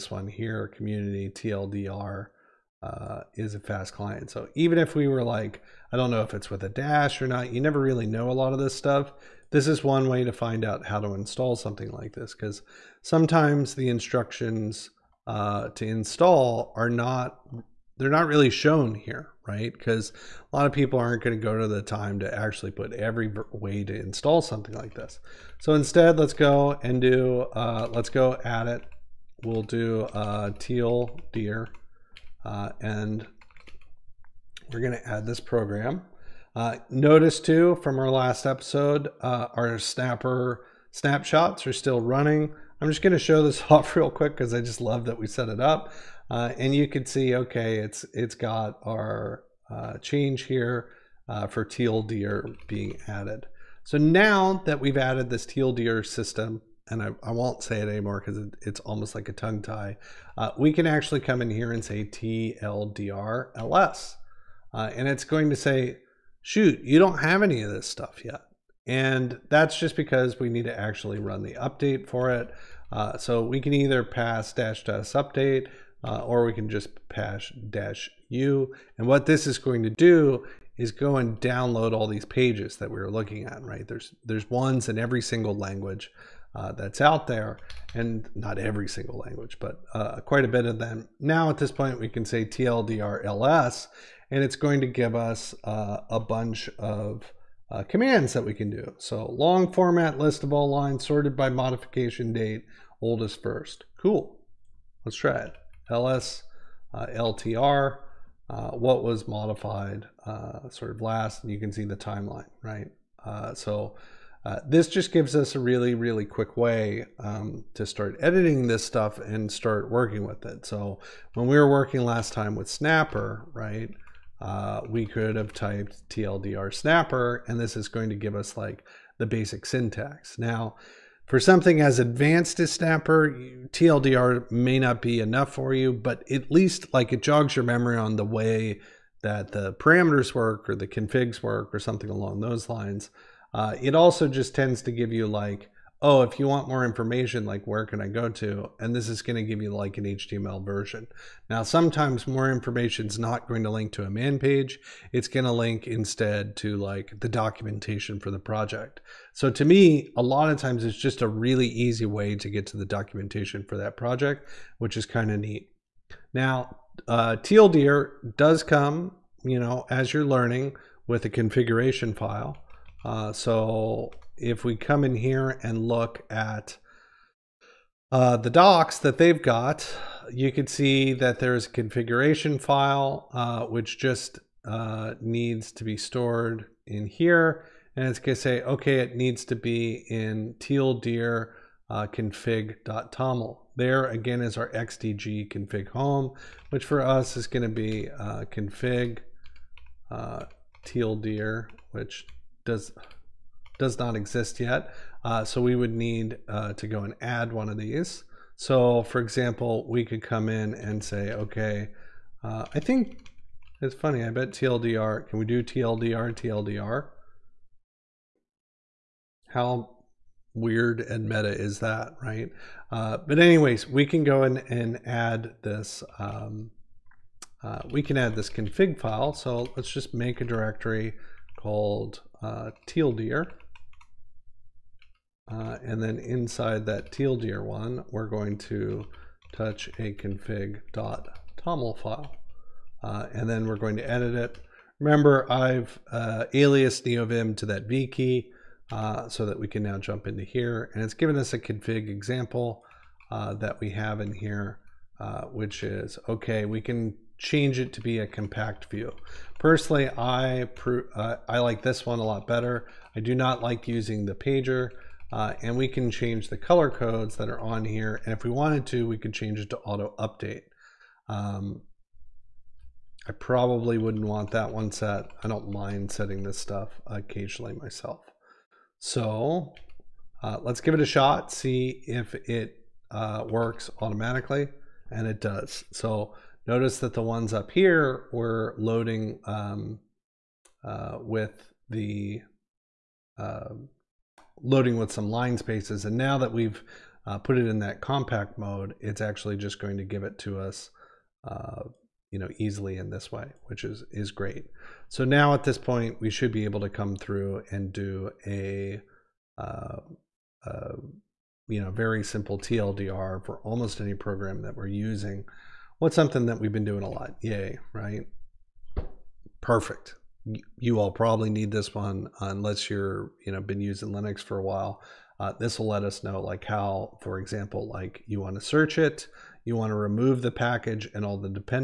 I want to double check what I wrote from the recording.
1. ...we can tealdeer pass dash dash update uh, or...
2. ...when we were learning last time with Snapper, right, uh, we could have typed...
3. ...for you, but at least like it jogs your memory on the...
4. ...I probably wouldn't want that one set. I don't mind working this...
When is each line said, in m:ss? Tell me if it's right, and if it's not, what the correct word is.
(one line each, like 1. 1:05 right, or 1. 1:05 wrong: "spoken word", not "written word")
1. 1:13 wrong: "either", not "tealdeer"
2. 2:01 wrong: "working", not "learning"
3. 2:15 right
4. 4:33 wrong: "setting", not "working".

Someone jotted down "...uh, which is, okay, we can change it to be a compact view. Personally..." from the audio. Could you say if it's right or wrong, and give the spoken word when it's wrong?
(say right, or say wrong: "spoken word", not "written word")
right.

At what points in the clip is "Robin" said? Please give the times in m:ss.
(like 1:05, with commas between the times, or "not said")
not said.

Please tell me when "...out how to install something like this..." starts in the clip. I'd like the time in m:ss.
0:10.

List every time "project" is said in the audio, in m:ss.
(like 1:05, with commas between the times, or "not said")
2:38, 2:43.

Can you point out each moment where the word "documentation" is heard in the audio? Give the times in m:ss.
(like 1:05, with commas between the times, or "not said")
2:37, 2:42.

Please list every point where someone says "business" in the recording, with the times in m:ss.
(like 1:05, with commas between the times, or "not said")
not said.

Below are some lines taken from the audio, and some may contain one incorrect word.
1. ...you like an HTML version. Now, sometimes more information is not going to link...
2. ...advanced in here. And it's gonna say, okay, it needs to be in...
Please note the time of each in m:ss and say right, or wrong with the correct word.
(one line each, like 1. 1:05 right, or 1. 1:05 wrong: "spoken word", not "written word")
1. 2:29 right
2. 3:05 wrong: "stored", not "advanced".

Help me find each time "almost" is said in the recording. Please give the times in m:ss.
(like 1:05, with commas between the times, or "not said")
0:58, 5:13.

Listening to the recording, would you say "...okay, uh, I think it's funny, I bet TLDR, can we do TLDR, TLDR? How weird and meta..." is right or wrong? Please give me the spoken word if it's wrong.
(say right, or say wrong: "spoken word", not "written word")
right.